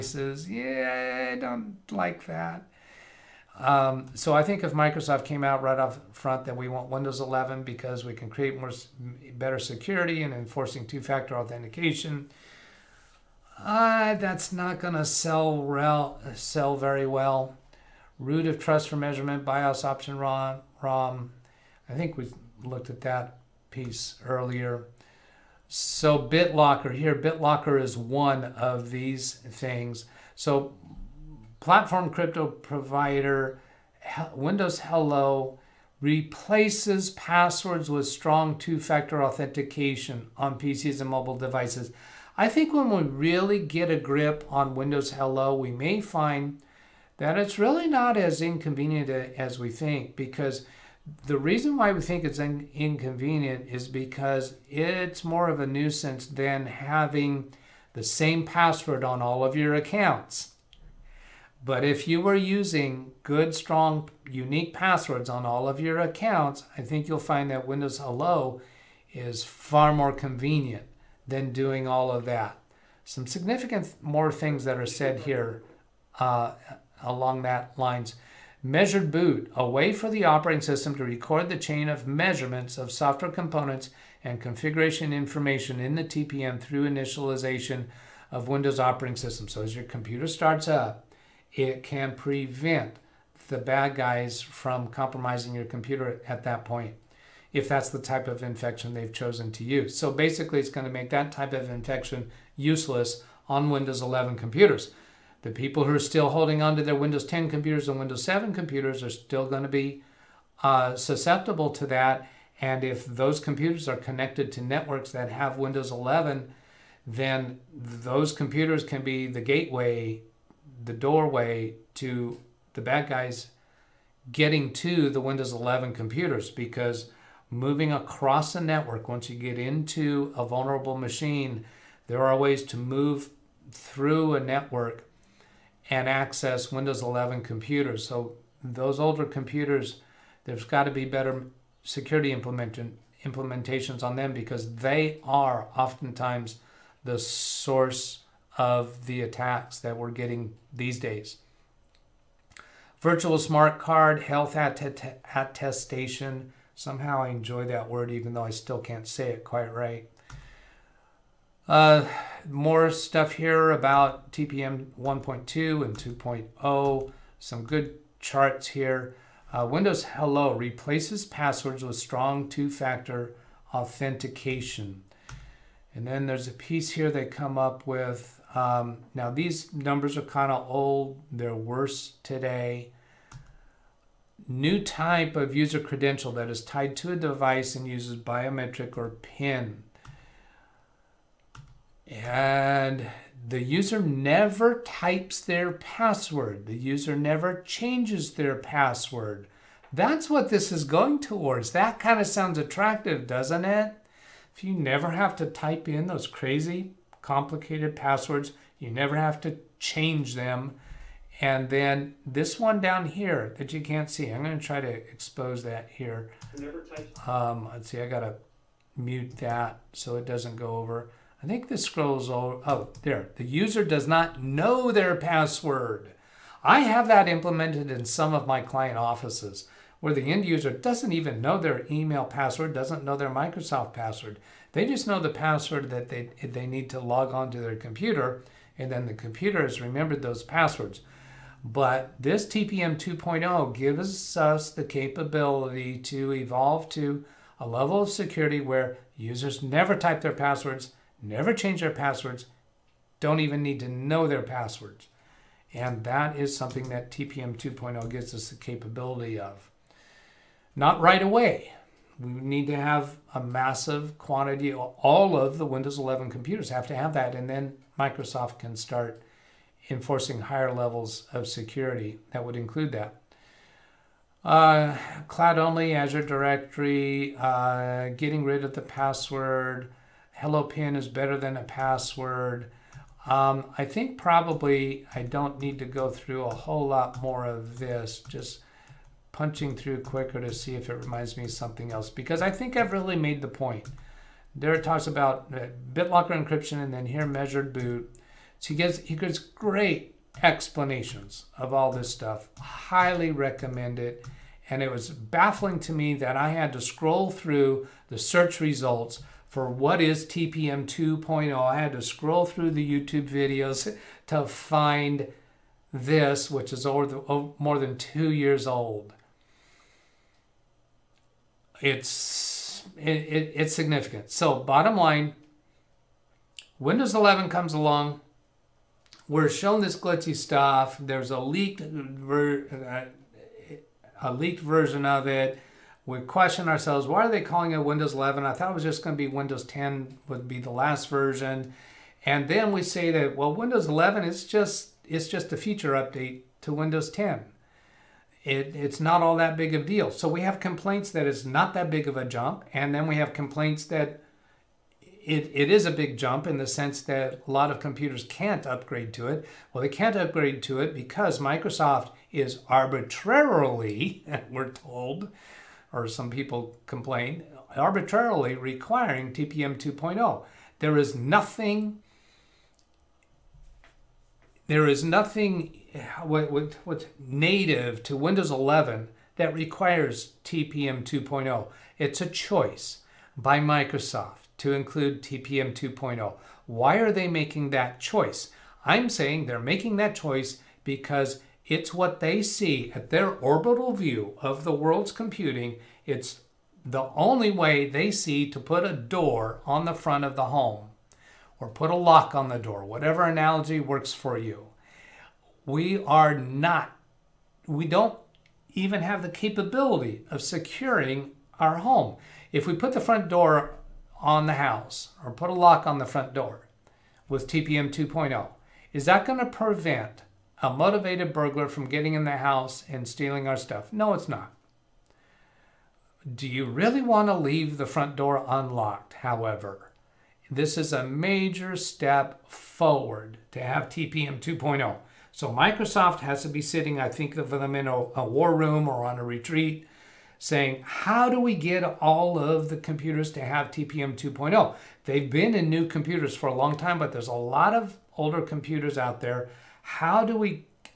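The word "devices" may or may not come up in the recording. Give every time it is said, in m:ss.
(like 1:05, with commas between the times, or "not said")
0:41, 3:07.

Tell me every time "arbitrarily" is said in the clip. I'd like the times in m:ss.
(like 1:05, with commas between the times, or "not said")
6:02, 6:07.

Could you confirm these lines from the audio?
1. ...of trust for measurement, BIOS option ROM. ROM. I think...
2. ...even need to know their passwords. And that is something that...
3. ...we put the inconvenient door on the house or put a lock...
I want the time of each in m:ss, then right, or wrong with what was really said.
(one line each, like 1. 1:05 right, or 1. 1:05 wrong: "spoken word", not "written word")
1. 0:18 right
2. 4:13 right
3. 6:52 wrong: "front", not "inconvenient".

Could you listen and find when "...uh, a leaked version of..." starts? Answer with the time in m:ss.
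5:31.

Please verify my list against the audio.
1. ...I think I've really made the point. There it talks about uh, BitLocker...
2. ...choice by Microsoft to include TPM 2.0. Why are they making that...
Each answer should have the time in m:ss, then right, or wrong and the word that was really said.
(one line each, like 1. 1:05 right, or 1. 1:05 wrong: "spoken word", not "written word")
1. 4:52 right
2. 6:22 right.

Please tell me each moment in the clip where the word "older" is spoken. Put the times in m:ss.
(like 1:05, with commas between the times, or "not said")
2:18, 7:28.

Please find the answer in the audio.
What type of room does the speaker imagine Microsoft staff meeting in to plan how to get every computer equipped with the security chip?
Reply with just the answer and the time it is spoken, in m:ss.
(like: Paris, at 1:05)
A war room, at 7:18.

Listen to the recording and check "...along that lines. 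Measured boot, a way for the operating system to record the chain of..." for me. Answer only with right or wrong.
right.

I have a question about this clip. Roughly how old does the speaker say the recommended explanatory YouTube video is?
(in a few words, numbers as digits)
More than 2 years.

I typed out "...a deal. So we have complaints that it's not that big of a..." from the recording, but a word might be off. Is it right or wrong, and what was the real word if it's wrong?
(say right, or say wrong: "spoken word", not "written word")
right.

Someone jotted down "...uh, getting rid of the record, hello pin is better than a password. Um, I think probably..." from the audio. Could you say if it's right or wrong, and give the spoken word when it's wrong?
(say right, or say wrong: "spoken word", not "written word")
wrong: "password", not "record".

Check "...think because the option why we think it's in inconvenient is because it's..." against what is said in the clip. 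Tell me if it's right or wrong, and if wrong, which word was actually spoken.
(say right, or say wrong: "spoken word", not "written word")
wrong: "reason", not "option".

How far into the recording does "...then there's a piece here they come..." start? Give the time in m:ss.
2:56.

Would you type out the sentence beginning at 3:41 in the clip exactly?
I think this scrolls all, oh, there.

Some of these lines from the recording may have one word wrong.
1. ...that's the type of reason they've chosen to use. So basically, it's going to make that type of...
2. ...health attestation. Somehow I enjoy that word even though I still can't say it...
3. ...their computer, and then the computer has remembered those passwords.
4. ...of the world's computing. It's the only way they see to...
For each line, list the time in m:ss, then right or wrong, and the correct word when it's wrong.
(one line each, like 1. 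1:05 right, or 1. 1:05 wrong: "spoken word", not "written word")
1. 1:37 wrong: "infection", not "reason"
2. 2:34 right
3. 3:57 right
4. 6:34 right.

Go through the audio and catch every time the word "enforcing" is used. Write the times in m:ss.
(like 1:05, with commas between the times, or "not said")
0:10, 4:29.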